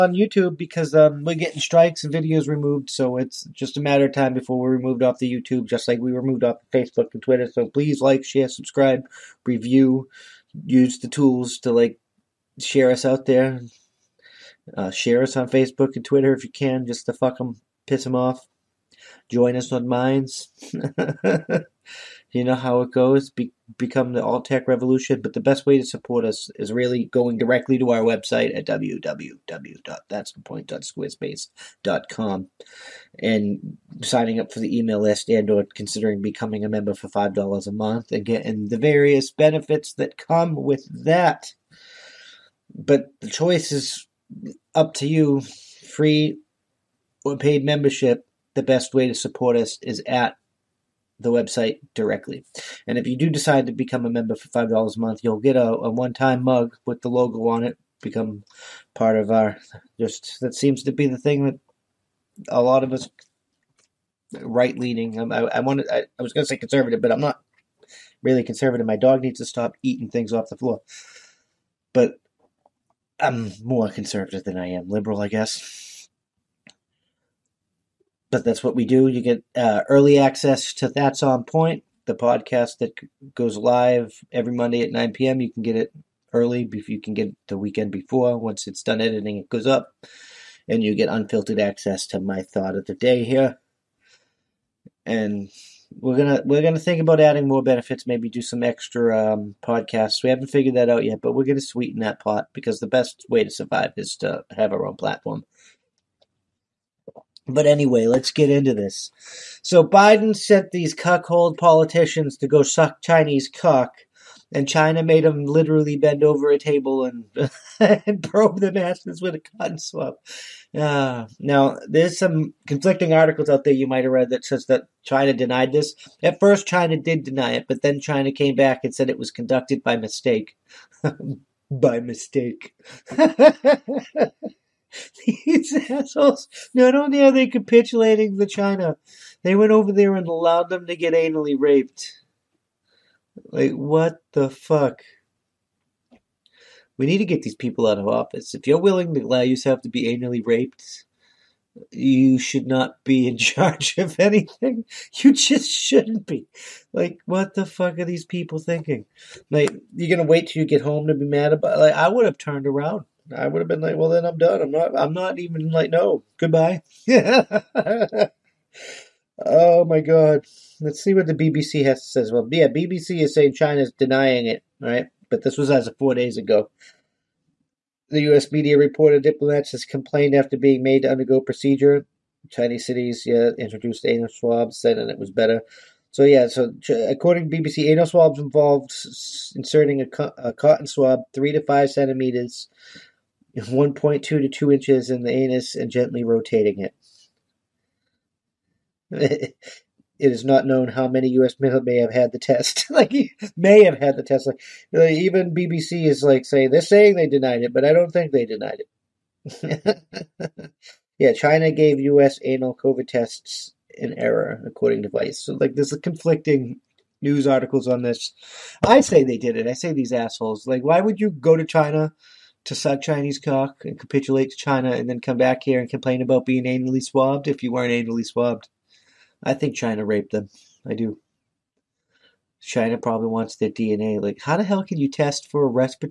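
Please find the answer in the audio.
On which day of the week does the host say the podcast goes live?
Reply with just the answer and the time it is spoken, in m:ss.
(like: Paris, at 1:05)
Monday, at 1:24.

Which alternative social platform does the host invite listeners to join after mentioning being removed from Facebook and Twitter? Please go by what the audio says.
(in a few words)
Minds.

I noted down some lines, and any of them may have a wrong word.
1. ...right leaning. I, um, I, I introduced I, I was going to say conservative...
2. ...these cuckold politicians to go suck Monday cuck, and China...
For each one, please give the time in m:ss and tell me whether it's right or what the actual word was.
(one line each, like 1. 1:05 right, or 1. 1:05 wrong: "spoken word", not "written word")
1. 1:04 wrong: "wanted", not "introduced"
2. 1:50 wrong: "Chinese", not "Monday".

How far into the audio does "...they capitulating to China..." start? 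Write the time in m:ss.
2:17.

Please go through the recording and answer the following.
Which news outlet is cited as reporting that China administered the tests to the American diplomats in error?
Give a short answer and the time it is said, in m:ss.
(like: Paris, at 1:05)
Vice, at 3:35.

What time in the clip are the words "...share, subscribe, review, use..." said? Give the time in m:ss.
0:08.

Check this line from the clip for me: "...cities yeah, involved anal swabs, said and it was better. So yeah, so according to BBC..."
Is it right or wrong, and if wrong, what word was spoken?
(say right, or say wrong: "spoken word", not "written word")
wrong: "introduced", not "involved".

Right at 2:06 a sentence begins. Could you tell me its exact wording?
At first, China did deny it, but then China came back and said it was conducted by mistake.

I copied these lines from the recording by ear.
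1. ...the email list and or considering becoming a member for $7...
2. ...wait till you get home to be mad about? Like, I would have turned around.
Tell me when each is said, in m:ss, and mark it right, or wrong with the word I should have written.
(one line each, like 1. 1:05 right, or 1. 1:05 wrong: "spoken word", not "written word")
1. 0:34 wrong: "5", not "7"
2. 2:40 right.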